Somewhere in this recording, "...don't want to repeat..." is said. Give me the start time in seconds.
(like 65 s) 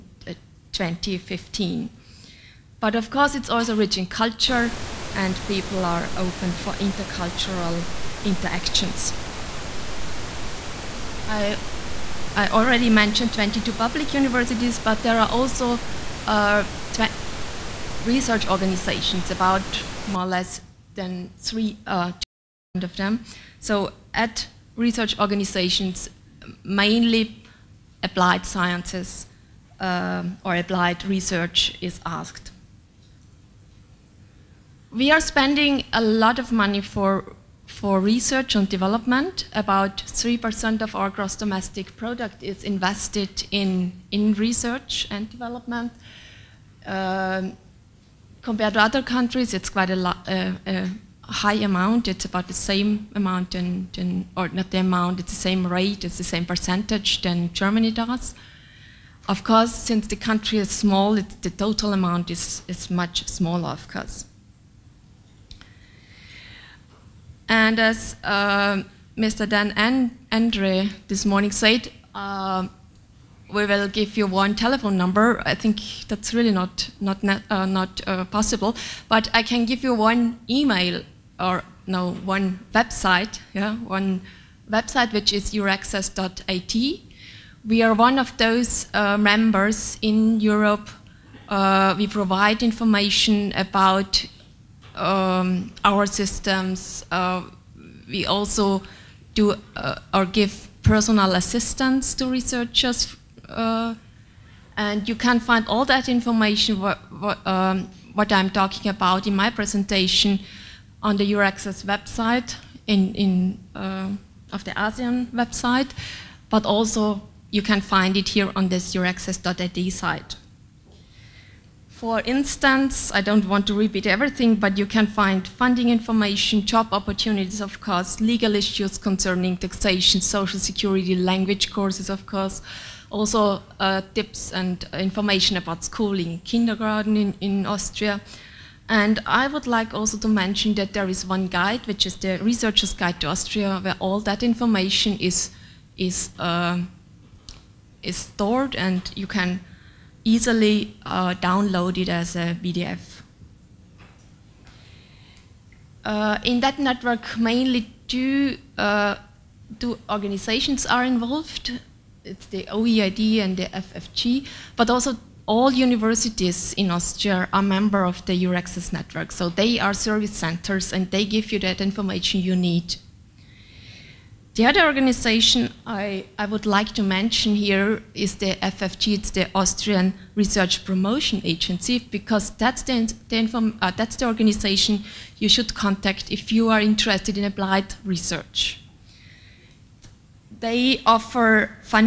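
123 s.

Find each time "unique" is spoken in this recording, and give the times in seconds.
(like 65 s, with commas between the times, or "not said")
not said.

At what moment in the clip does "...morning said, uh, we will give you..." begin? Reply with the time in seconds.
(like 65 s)
71 s.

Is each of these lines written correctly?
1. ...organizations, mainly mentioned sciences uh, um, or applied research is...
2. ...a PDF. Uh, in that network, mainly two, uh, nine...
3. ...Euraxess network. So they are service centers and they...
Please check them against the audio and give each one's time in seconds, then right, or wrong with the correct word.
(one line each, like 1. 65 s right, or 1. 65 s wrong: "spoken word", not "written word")
1. 25 s wrong: "applied", not "mentioned"
2. 152 s wrong: "two", not "nine"
3. 168 s right.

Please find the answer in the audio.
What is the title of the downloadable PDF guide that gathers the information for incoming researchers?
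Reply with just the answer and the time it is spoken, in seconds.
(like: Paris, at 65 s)
Researcher's Guide to Austria, at 142 s.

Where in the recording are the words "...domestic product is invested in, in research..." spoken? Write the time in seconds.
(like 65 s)
41 s.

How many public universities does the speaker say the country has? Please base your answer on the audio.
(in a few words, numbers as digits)
22.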